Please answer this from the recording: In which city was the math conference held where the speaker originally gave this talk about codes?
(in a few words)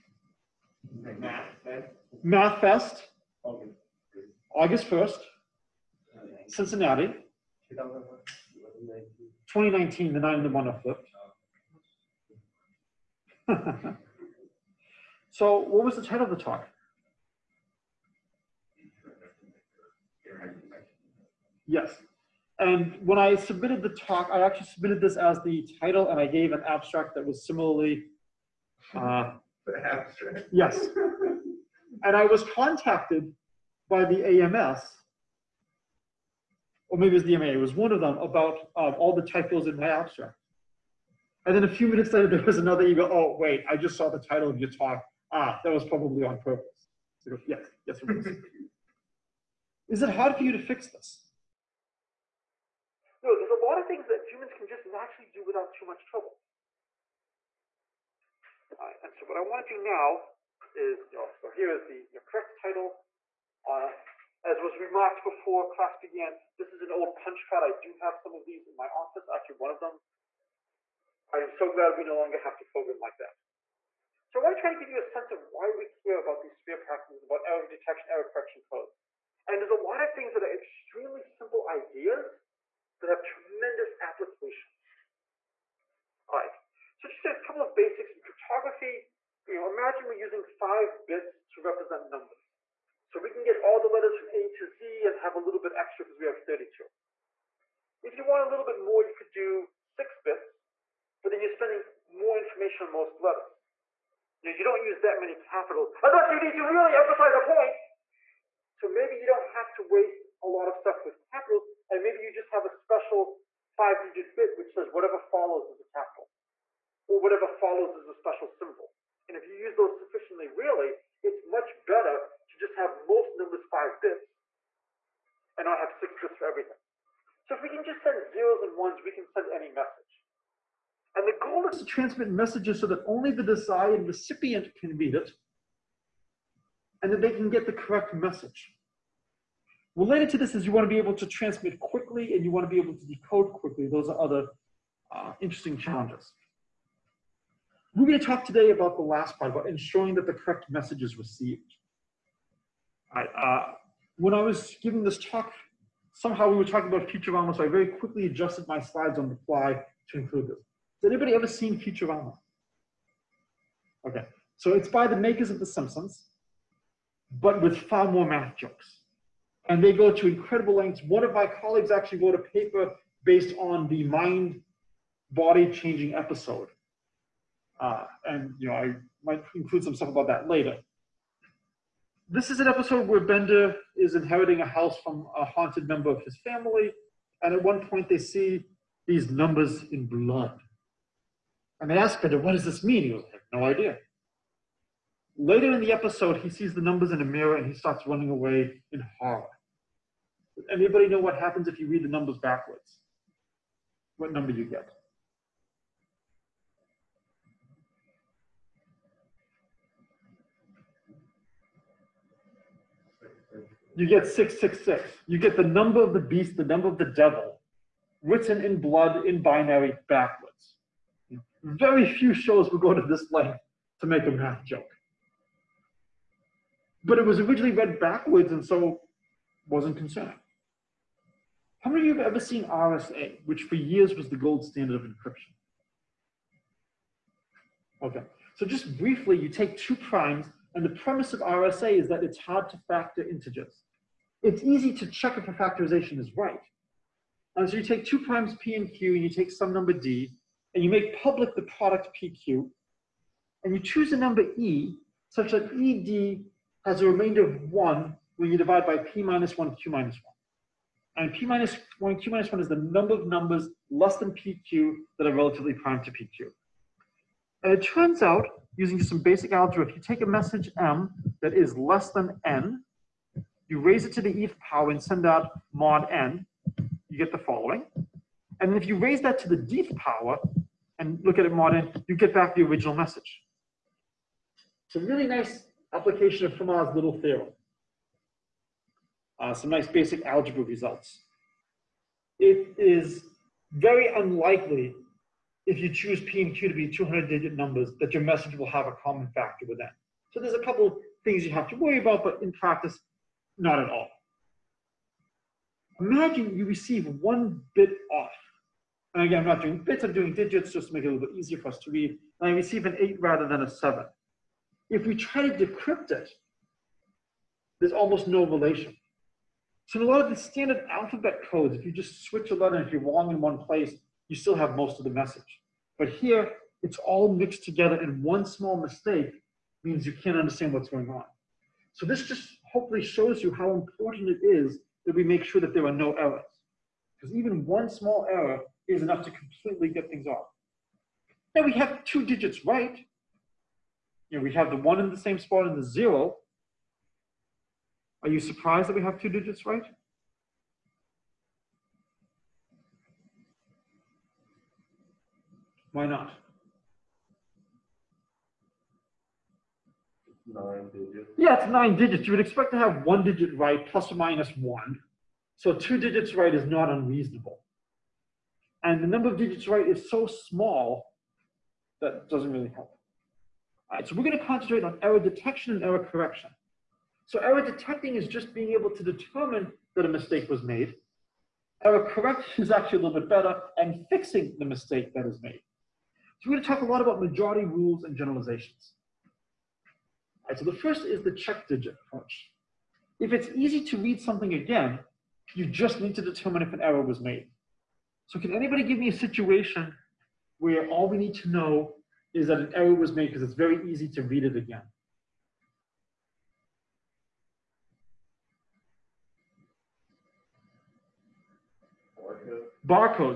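Cincinnati.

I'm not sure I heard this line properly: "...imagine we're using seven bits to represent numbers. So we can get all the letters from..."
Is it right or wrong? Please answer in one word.
wrong.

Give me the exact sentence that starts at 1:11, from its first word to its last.
I am so glad we no longer have to program like that.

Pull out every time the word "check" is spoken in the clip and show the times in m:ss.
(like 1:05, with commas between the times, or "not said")
4:05, 6:31.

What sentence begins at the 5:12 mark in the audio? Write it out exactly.
And I receive an eight rather than a seven.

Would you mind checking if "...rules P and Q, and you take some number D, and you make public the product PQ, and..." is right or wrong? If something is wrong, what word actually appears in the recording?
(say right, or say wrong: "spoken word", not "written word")
wrong: "primes", not "rules".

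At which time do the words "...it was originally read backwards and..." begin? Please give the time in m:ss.
3:47.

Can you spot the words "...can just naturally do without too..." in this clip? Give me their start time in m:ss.
0:54.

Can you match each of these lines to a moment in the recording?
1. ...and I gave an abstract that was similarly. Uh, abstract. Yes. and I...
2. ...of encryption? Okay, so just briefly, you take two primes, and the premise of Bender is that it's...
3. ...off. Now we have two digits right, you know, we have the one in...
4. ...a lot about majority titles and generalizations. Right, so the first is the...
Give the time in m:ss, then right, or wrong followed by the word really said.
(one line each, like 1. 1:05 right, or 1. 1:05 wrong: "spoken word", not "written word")
1. 0:26 right
2. 3:54 wrong: "RSA", not "Bender"
3. 5:40 right
4. 6:26 wrong: "rules", not "titles".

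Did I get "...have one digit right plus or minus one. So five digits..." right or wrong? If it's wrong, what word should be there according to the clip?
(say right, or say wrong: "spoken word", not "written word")
wrong: "two", not "five".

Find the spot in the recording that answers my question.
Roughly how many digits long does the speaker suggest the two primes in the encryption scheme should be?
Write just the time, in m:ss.
4:56.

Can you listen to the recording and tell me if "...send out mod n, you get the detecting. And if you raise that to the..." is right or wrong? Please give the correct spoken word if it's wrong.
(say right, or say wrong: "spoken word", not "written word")
wrong: "following", not "detecting".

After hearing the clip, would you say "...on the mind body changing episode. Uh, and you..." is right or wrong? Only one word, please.
right.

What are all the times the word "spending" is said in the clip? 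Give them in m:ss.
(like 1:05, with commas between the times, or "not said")
1:41.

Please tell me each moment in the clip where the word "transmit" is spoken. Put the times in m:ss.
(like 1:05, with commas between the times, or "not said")
2:11, 2:21.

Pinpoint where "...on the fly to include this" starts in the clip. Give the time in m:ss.
2:39.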